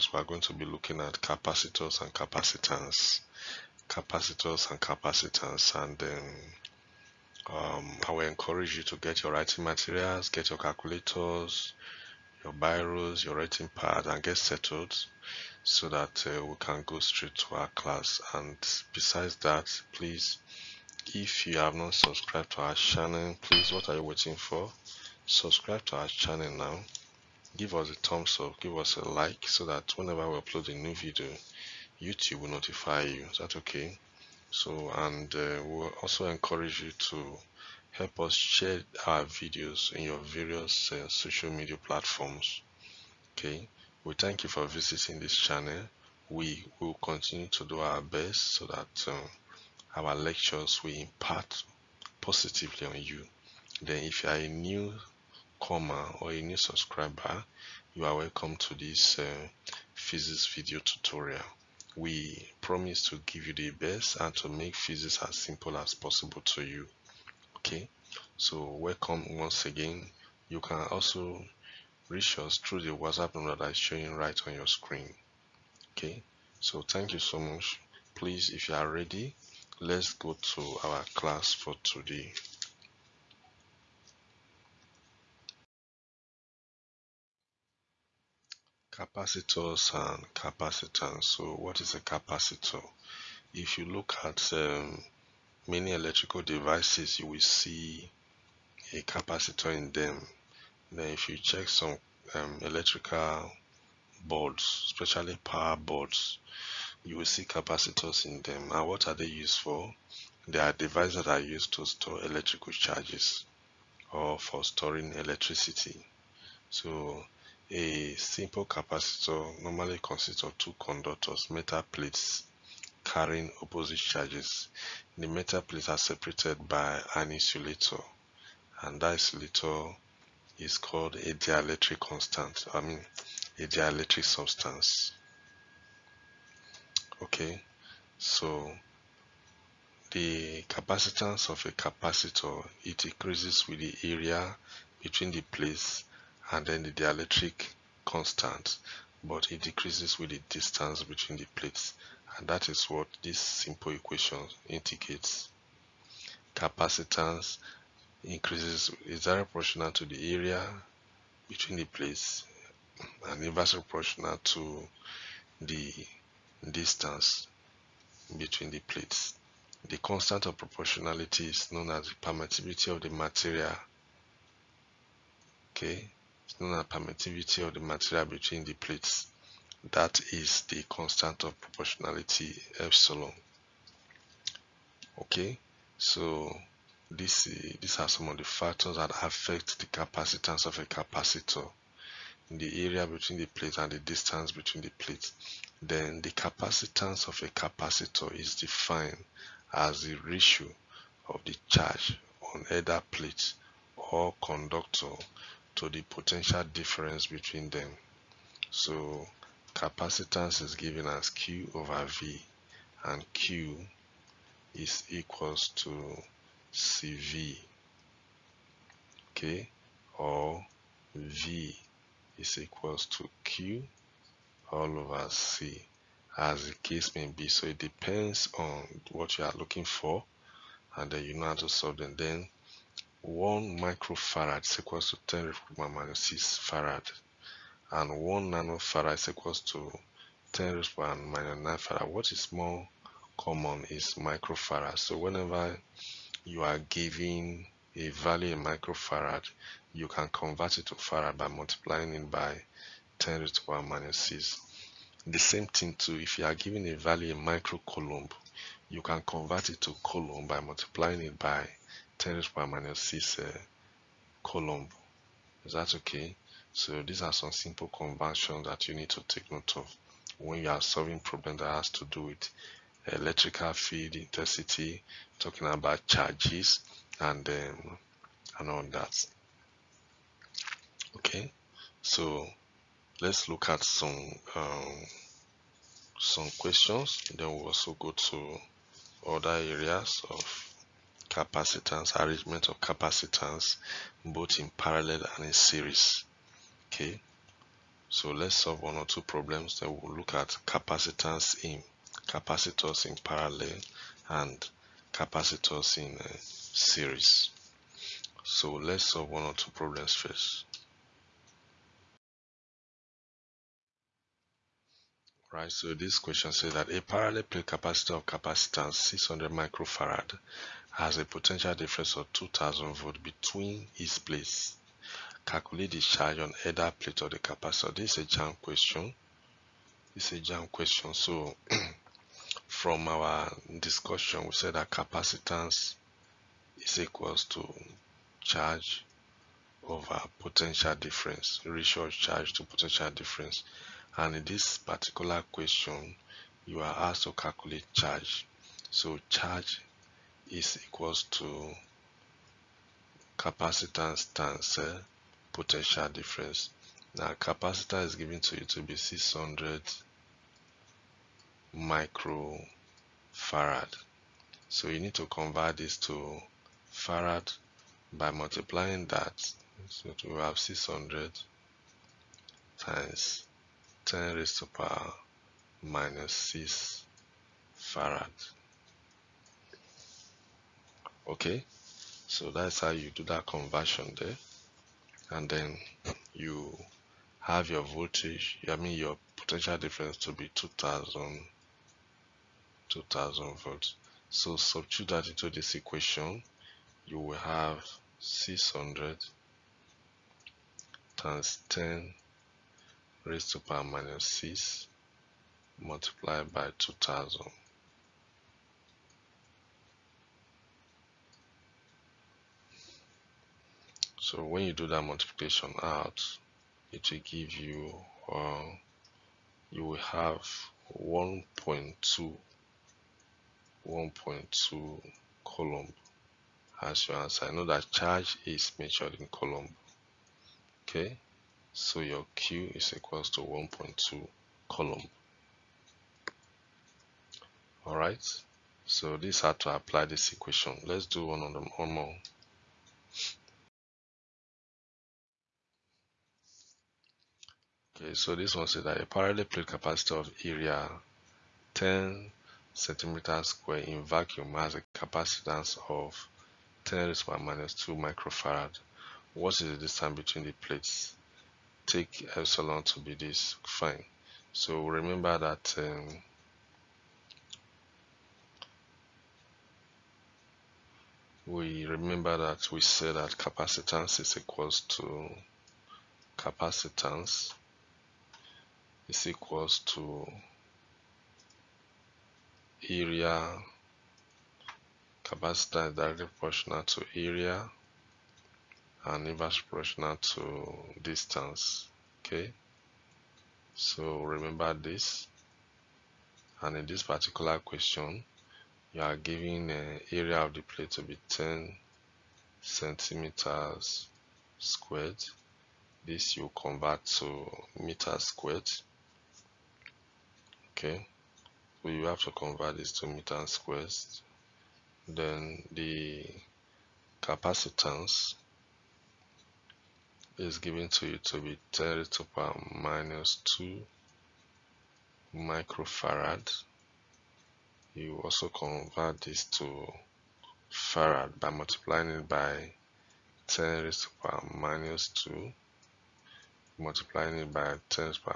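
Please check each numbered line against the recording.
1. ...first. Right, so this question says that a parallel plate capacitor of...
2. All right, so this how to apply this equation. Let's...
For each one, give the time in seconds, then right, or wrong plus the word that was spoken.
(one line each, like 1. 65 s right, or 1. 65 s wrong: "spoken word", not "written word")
1. 310 s right
2. 437 s right.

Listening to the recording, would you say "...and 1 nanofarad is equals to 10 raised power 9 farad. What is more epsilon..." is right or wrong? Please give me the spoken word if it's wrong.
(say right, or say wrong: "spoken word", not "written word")
wrong: "common", not "epsilon".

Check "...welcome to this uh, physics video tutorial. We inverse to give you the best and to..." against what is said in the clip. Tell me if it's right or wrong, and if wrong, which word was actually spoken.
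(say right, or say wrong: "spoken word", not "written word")
wrong: "promise", not "inverse".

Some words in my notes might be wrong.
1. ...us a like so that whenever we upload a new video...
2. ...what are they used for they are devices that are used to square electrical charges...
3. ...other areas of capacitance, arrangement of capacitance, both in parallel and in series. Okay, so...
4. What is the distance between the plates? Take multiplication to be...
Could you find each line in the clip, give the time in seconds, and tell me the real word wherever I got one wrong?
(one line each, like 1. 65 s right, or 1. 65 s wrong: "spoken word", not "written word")
1. 28 s right
2. 108 s wrong: "store", not "square"
3. 289 s right
4. 459 s wrong: "epsilon", not "multiplication".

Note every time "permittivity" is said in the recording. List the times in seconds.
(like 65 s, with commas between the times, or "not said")
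172 s, 176 s.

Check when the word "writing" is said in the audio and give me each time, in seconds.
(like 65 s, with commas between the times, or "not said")
9 s, 13 s.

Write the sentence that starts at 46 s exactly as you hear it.
We will continue to do our best so that um, our lectures will impact positively on you.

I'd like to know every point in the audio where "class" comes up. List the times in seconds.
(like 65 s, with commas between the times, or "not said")
17 s, 81 s.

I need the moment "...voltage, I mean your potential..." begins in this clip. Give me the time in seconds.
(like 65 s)
387 s.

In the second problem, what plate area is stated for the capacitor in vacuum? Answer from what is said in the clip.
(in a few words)
10 square centimeters.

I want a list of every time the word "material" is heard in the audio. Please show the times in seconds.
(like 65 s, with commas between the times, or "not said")
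9 s, 173 s, 177 s.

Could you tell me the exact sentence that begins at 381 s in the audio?
Okay, so that's how you do that conversion there.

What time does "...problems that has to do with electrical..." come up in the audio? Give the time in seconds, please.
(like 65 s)
271 s.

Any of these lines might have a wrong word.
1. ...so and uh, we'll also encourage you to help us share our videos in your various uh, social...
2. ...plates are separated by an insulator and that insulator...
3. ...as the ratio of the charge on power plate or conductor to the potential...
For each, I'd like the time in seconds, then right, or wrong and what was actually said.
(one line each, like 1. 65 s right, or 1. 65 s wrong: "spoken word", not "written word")
1. 34 s right
2. 125 s right
3. 199 s wrong: "either", not "power".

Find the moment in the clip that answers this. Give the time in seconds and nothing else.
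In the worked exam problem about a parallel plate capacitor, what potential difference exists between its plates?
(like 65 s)
322 s.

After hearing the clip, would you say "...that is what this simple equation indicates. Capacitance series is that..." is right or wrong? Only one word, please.
wrong.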